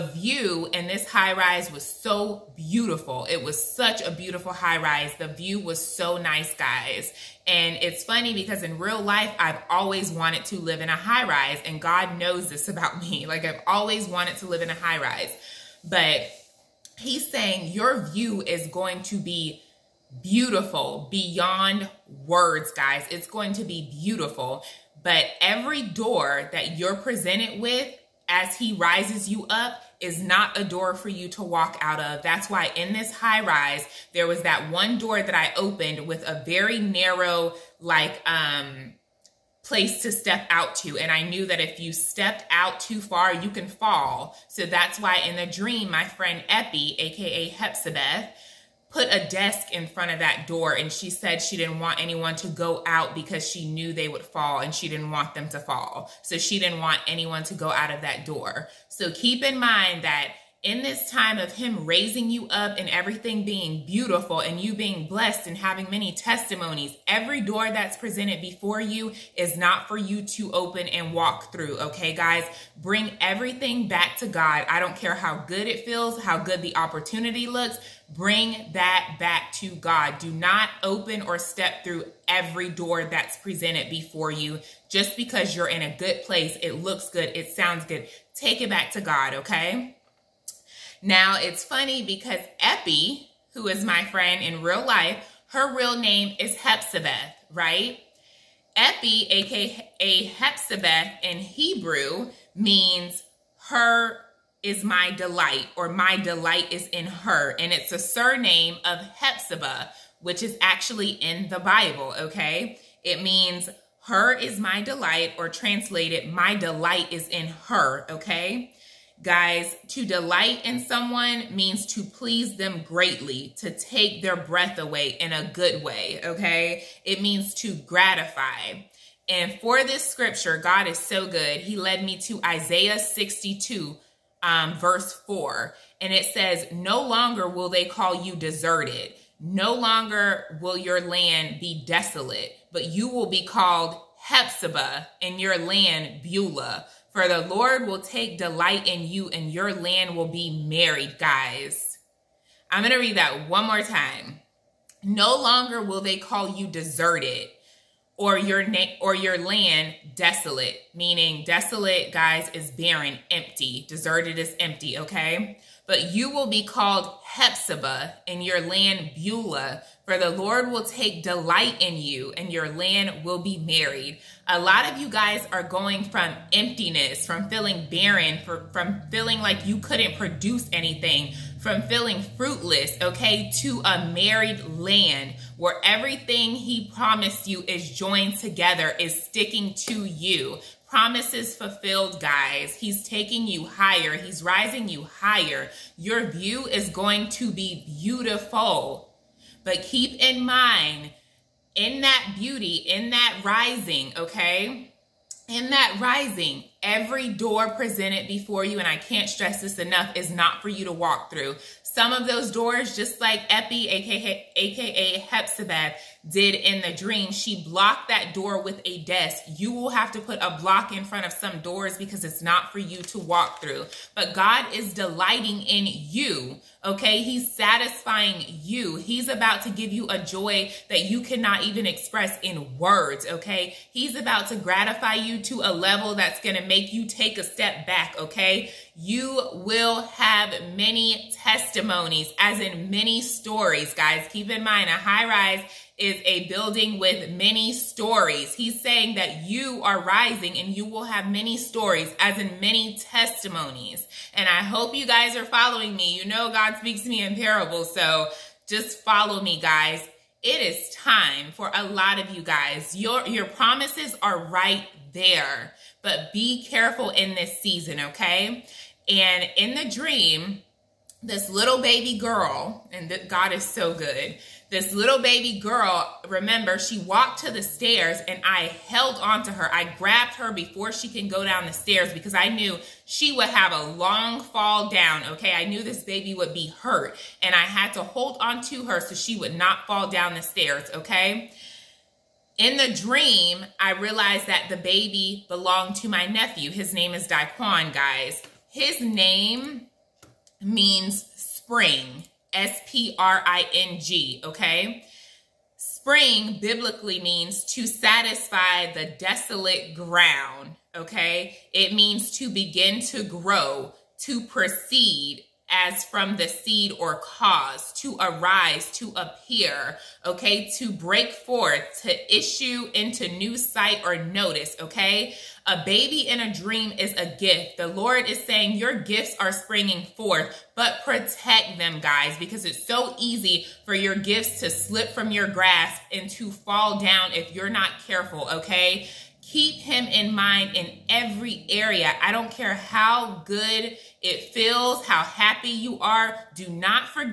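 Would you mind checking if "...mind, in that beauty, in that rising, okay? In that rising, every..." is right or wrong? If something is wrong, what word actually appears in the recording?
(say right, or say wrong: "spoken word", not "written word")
right.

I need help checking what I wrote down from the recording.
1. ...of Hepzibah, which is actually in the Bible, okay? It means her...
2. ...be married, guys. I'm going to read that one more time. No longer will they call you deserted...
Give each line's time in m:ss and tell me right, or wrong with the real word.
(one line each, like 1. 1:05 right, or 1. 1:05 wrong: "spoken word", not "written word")
1. 1:48 right
2. 2:30 right.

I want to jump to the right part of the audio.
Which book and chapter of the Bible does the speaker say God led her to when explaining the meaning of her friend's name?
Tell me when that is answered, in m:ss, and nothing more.
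2:12.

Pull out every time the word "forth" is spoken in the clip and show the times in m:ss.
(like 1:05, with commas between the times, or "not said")
5:21, 5:30.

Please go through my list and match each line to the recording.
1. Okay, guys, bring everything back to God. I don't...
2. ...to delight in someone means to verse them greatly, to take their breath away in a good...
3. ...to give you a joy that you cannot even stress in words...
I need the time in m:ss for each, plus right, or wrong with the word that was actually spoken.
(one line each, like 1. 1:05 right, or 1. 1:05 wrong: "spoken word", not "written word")
1. 1:11 right
2. 1:59 wrong: "please", not "verse"
3. 3:49 wrong: "express", not "stress".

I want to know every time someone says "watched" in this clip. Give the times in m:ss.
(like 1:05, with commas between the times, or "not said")
not said.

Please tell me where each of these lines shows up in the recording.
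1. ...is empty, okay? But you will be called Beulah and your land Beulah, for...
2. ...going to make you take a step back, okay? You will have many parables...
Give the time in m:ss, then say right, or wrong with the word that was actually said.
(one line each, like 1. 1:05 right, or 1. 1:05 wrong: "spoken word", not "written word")
1. 2:44 wrong: "Hephzibah", not "Beulah"
2. 3:56 wrong: "testimonies", not "parables".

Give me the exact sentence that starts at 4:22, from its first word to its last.
Your, your promises are right there, but be careful in this season, okay?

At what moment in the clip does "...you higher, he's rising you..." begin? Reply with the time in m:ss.
3:13.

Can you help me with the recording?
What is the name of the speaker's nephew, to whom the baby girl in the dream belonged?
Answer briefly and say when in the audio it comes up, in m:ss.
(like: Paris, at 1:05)
Daquan, at 4:57.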